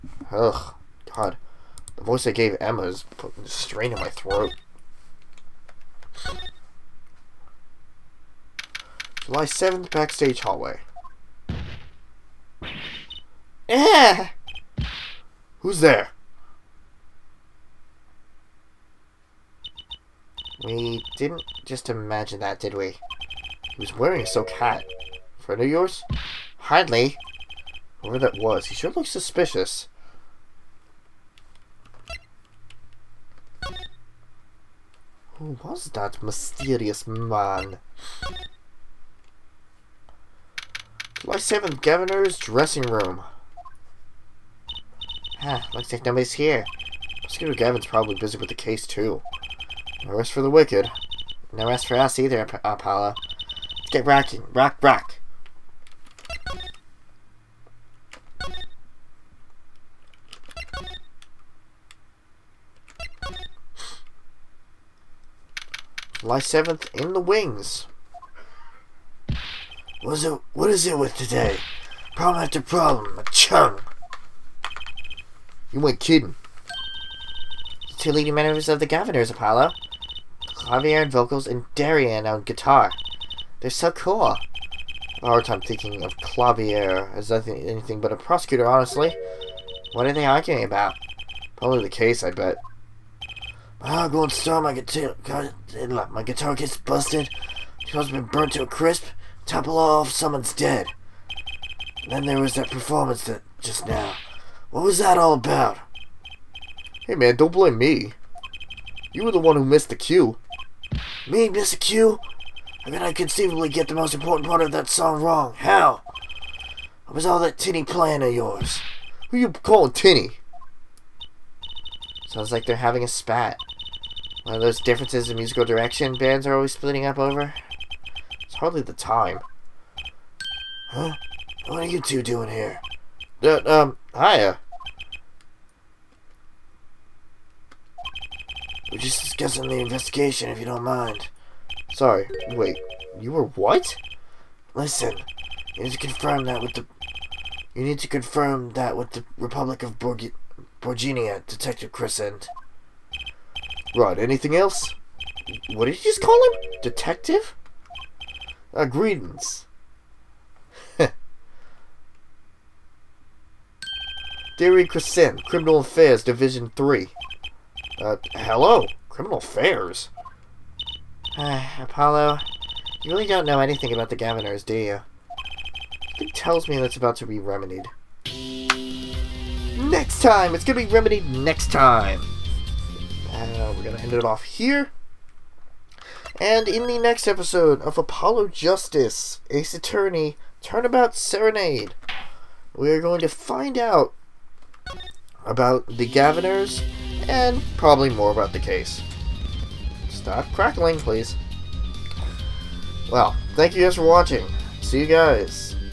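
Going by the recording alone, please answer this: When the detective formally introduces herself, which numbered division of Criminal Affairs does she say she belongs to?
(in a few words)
Division 3.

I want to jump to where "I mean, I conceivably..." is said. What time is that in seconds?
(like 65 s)
112 s.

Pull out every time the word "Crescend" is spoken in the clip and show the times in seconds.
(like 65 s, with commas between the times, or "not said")
151 s, 164 s.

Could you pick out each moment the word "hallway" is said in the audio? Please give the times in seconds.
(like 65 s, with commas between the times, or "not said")
10 s.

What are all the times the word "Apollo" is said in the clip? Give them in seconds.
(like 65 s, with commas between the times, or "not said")
52 s, 79 s, 171 s, 187 s.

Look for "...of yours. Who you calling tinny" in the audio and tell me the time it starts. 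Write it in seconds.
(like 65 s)
118 s.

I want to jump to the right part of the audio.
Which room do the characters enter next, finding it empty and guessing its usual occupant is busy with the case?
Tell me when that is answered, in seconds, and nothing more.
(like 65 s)
41 s.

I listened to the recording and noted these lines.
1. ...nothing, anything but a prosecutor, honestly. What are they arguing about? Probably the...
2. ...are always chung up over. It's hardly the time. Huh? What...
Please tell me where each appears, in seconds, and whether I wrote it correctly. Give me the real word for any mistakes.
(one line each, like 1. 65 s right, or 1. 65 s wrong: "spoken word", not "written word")
1. 87 s right
2. 126 s wrong: "splitting", not "chung".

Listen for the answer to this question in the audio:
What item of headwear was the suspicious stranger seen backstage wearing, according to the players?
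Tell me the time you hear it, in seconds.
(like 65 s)
24 s.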